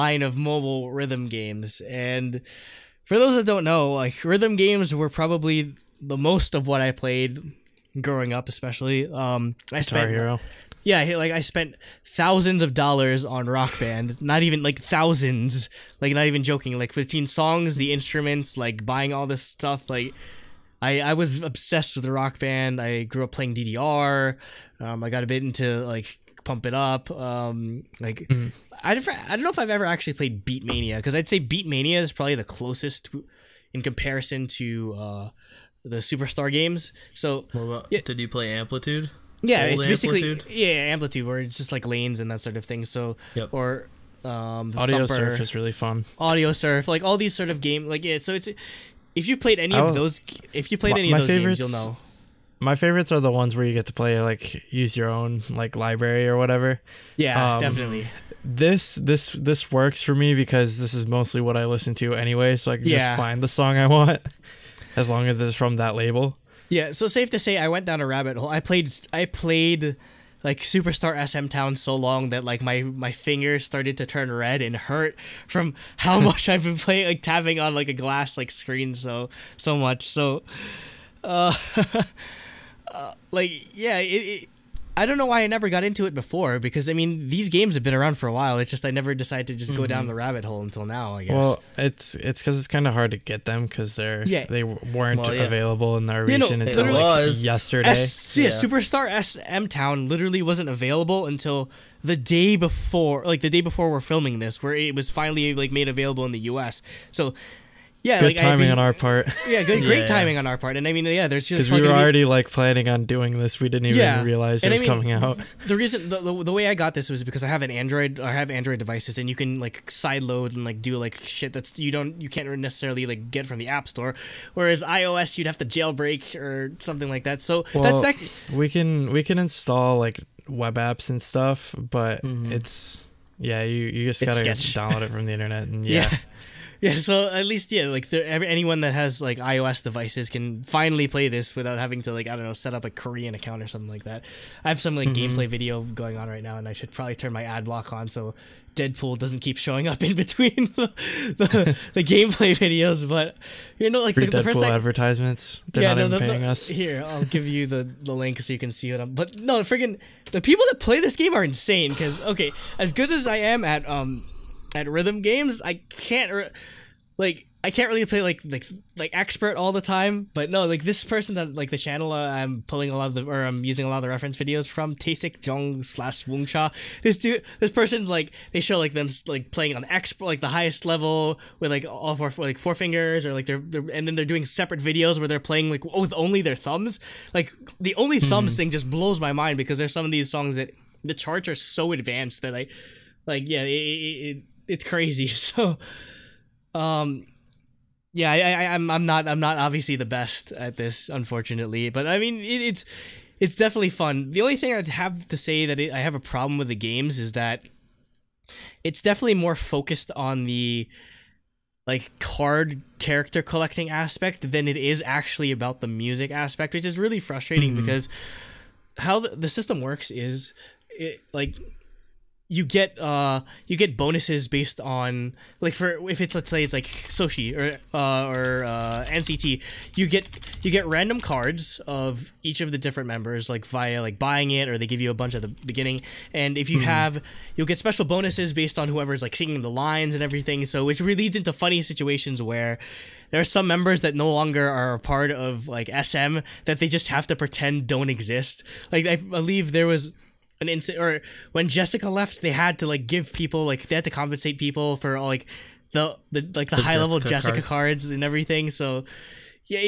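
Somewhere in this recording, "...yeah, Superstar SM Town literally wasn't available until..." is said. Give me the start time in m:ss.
1:38.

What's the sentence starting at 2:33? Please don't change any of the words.
But you know, like Free the, the I, advertisements, they're yeah, not no, even paying us.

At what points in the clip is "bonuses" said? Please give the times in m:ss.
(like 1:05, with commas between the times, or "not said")
3:43, 3:58.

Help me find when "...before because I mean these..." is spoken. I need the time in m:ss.
1:26.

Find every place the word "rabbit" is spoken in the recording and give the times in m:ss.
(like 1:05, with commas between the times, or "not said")
1:08, 1:30.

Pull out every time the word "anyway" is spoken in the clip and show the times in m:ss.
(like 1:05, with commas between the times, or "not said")
1:02.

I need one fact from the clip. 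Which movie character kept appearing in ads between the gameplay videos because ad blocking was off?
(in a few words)
Deadpool.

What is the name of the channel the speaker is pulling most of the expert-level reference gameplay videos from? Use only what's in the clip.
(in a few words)
Tae-Sik Jeong.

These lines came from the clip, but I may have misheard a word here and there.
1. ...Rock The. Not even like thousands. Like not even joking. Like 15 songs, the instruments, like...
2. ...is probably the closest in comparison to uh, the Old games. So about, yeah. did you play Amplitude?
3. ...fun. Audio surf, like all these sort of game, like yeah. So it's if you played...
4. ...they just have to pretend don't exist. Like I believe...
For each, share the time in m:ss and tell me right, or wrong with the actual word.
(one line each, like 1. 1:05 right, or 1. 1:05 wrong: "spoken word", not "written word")
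1. 0:13 wrong: "Band", not "The"
2. 0:32 wrong: "Superstar", not "Old"
3. 0:45 right
4. 4:06 right.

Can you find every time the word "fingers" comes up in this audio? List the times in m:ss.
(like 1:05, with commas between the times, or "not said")
1:13, 3:02.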